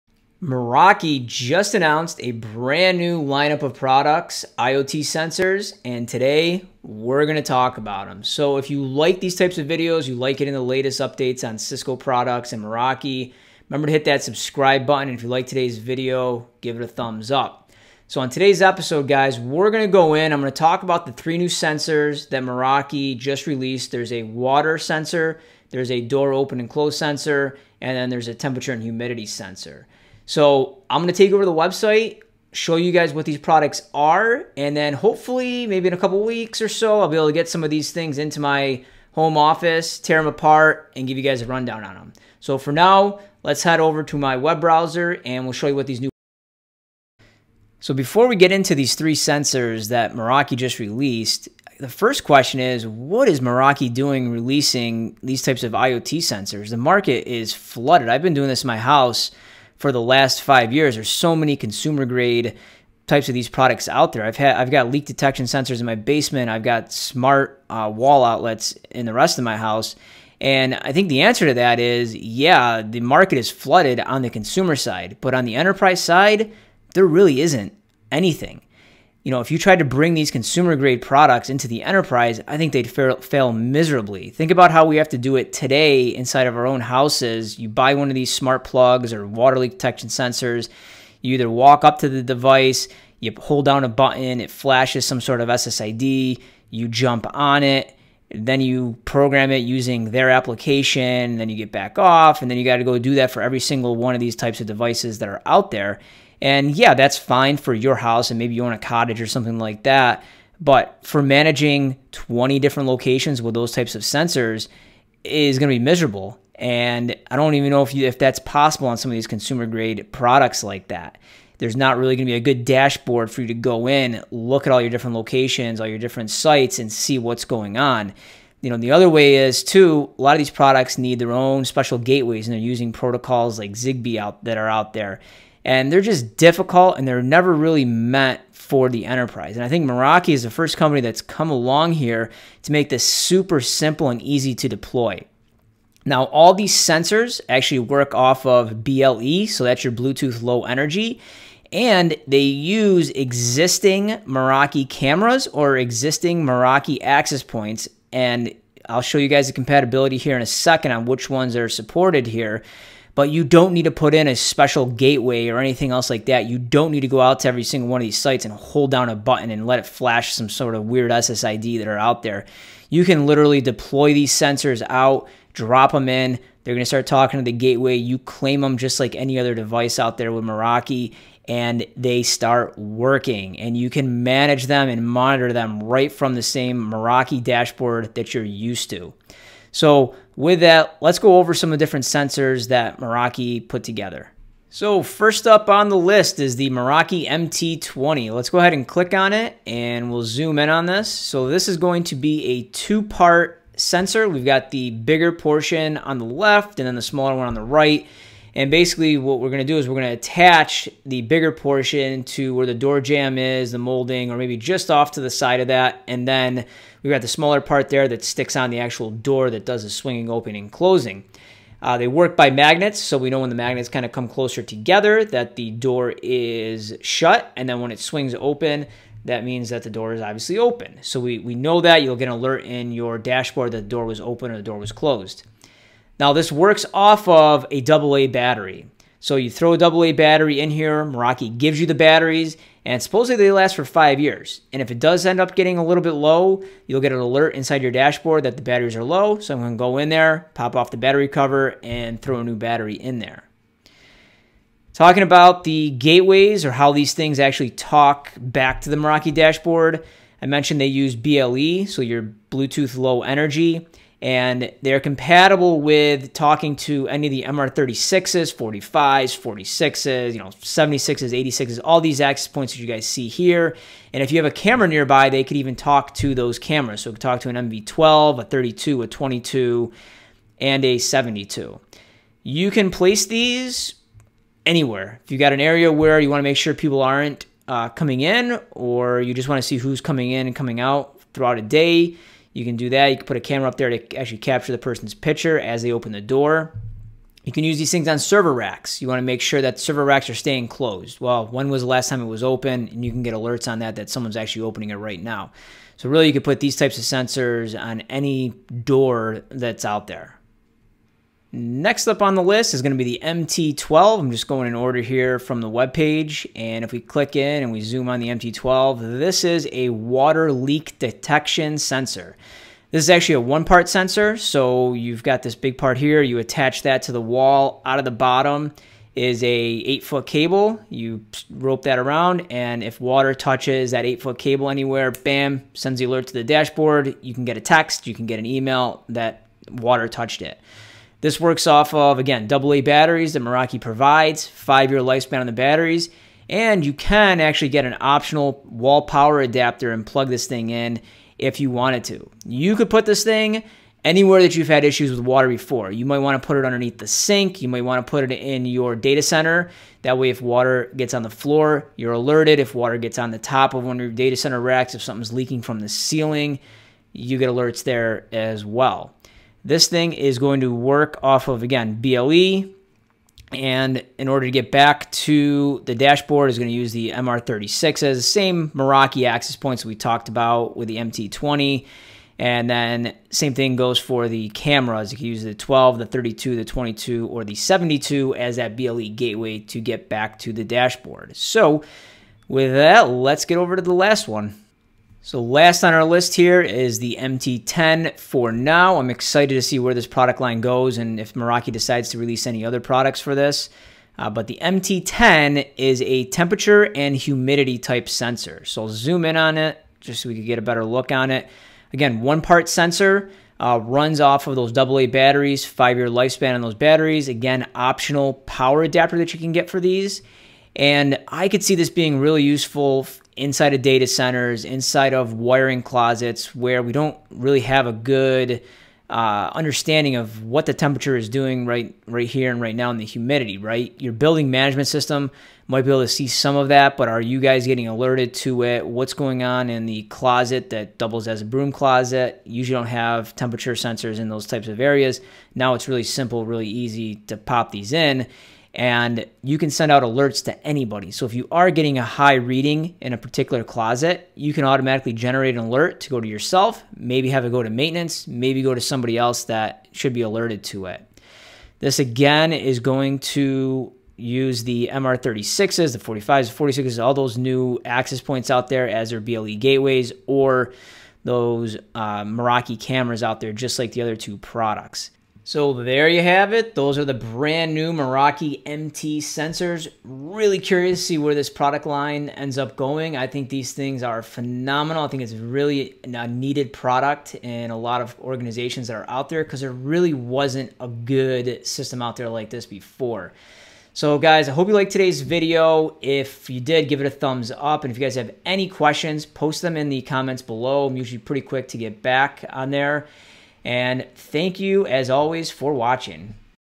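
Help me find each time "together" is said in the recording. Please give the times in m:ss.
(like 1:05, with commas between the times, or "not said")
3:13, 3:44.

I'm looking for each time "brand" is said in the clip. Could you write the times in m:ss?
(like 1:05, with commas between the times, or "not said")
0:02, 7:57.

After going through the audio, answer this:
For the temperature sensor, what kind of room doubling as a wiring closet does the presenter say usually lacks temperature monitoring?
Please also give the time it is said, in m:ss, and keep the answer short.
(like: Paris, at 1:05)
Broom closet, at 7:21.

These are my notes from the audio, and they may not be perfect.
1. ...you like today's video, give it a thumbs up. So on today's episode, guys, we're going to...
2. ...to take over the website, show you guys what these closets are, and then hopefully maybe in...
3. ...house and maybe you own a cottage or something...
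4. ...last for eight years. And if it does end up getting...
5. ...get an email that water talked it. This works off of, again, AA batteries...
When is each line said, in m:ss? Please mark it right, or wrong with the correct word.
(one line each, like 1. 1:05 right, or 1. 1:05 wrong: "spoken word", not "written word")
1. 0:15 right
2. 0:31 wrong: "products", not "closets"
3. 1:47 right
4. 4:03 wrong: "five", not "eight"
5. 5:38 wrong: "touched", not "talked".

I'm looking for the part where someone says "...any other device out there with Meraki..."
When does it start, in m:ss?
2:59.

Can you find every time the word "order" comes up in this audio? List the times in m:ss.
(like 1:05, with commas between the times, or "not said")
5:14, 6:14.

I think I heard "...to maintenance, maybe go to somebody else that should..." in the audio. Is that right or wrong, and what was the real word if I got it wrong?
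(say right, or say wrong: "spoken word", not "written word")
right.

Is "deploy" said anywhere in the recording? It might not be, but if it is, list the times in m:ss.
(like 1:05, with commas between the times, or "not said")
2:24, 2:53.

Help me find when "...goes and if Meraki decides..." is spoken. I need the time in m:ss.
6:40.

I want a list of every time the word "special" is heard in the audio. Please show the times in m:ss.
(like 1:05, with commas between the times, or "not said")
2:11, 2:44.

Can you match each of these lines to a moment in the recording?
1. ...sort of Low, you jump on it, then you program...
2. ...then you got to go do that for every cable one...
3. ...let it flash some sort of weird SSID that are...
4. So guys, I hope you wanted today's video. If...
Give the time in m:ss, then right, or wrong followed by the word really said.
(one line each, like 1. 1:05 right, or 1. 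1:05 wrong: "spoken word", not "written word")
1. 1:35 wrong: "SSID", not "Low"
2. 1:42 wrong: "single", not "cable"
3. 2:49 right
4. 8:13 wrong: "liked", not "wanted".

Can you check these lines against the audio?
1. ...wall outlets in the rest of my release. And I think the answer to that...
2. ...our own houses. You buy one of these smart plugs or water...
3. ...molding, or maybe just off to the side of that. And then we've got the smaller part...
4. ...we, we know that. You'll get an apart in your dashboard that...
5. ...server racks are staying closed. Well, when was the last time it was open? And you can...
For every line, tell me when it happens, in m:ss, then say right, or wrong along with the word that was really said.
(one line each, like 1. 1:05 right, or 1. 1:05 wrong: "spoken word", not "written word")
1. 1:07 wrong: "house", not "release"
2. 1:26 right
3. 3:33 right
4. 3:51 wrong: "alert", not "apart"
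5. 4:59 right.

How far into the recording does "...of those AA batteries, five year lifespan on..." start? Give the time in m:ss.
6:54.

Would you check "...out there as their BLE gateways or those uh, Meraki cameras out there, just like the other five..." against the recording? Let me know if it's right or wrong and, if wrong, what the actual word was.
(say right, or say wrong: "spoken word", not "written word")
wrong: "two", not "five".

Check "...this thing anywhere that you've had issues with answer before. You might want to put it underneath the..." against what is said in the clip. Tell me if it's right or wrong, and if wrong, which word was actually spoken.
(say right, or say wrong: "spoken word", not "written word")
wrong: "water", not "answer".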